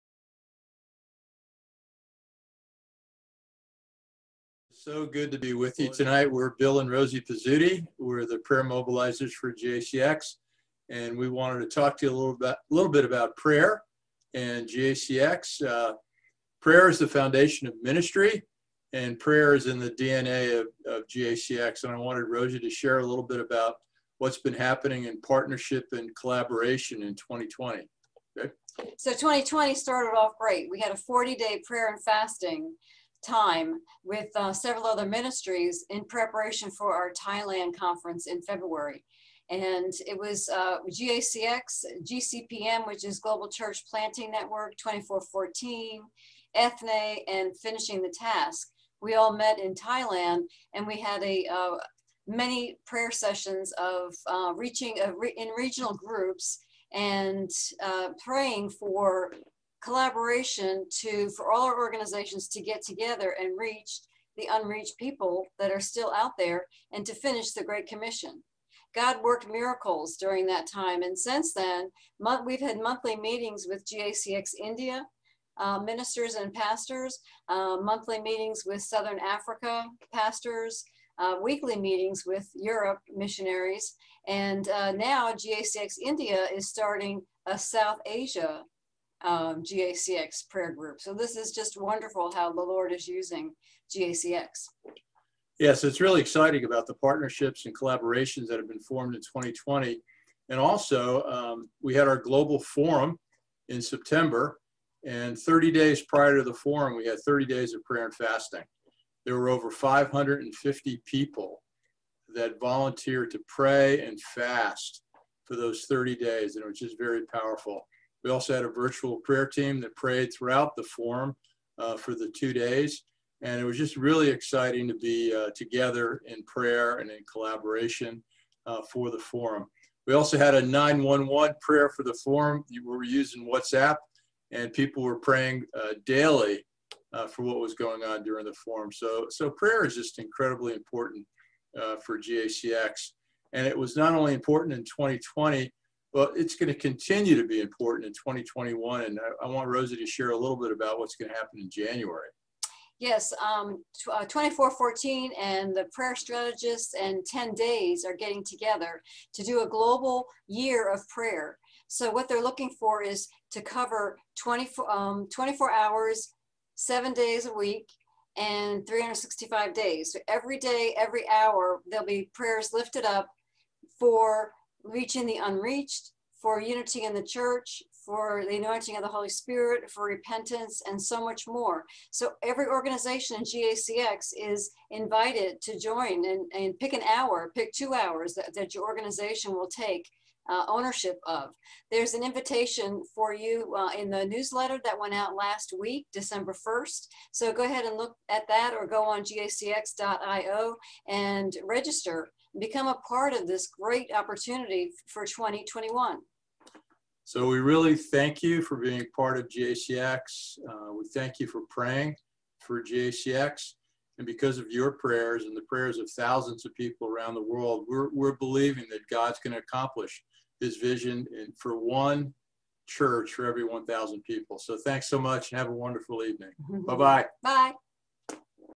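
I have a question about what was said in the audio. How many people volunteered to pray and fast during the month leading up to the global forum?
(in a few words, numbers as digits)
over 550.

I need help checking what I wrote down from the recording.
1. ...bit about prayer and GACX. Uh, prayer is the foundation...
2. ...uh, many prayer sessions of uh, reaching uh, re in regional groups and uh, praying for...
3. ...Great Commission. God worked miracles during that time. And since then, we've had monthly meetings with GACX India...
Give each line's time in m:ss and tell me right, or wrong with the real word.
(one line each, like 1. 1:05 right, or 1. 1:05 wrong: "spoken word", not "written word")
1. 0:12 right
2. 0:51 right
3. 1:07 right.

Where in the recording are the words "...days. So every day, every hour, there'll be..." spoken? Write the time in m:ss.
2:49.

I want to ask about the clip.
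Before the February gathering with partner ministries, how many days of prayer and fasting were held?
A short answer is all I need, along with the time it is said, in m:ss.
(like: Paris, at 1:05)
40, at 0:30.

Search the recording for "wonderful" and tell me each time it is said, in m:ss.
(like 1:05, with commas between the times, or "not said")
1:31, 3:45.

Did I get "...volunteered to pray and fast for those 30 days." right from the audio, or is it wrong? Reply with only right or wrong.
right.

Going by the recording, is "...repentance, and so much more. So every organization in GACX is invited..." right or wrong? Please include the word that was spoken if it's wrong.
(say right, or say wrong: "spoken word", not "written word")
right.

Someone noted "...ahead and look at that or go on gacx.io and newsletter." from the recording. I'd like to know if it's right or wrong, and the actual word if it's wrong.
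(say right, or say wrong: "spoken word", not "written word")
wrong: "register", not "newsletter".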